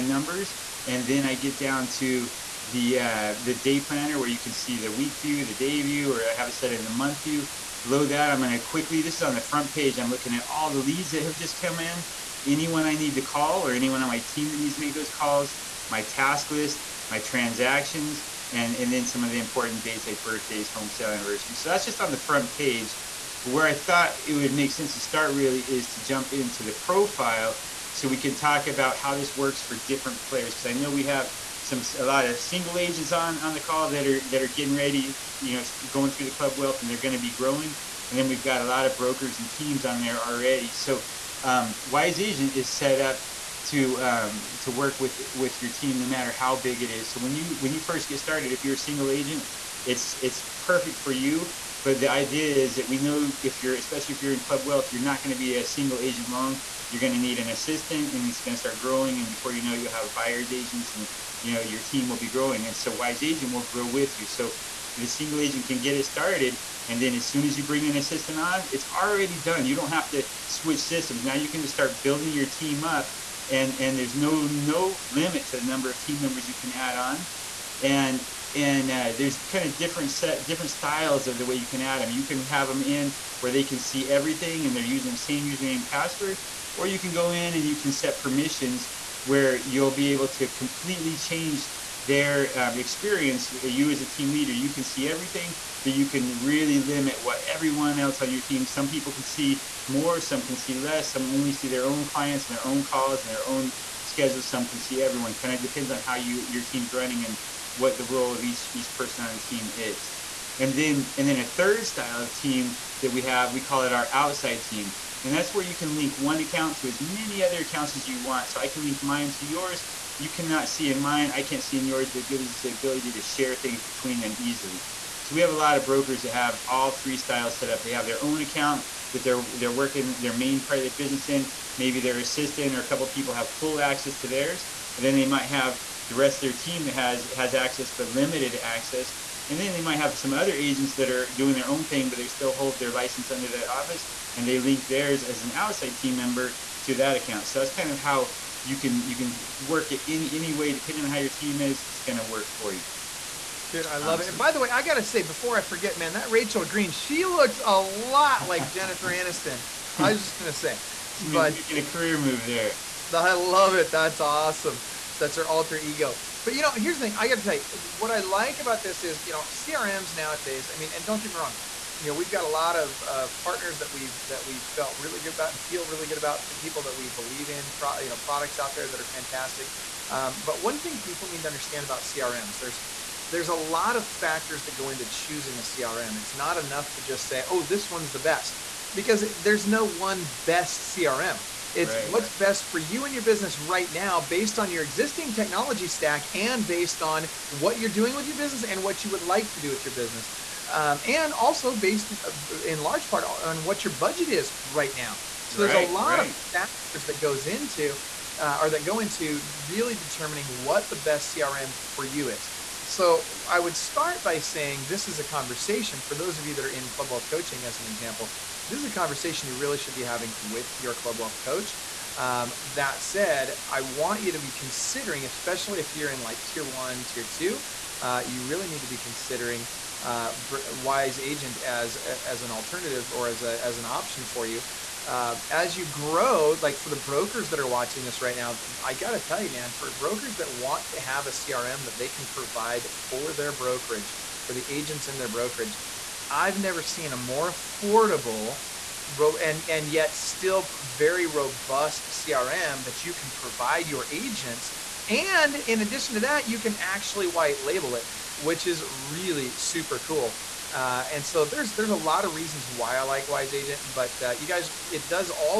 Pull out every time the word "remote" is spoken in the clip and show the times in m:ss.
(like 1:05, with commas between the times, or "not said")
not said.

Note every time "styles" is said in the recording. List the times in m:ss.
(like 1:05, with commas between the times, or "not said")
1:20, 1:51, 2:07.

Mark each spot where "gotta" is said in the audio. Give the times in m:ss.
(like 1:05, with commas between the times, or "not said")
2:34, 2:47, 3:58.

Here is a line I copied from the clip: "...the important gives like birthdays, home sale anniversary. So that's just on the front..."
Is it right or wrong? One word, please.
wrong.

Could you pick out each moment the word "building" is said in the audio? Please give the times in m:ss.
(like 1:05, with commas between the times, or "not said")
1:12.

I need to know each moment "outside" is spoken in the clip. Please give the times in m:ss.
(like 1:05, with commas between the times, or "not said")
1:54, 2:25.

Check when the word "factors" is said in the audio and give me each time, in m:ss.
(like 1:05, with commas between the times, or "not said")
3:04, 3:26.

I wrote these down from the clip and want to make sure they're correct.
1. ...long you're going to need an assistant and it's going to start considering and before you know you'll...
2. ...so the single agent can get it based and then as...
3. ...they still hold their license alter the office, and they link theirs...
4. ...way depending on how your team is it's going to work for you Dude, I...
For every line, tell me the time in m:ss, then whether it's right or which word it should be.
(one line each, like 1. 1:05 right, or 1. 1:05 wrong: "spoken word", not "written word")
1. 0:56 wrong: "growing", not "considering"
2. 1:04 wrong: "started", not "based"
3. 2:22 wrong: "under", not "alter"
4. 2:30 right.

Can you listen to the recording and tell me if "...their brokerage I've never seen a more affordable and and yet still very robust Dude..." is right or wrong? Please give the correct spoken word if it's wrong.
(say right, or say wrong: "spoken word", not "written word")
wrong: "CRM", not "Dude".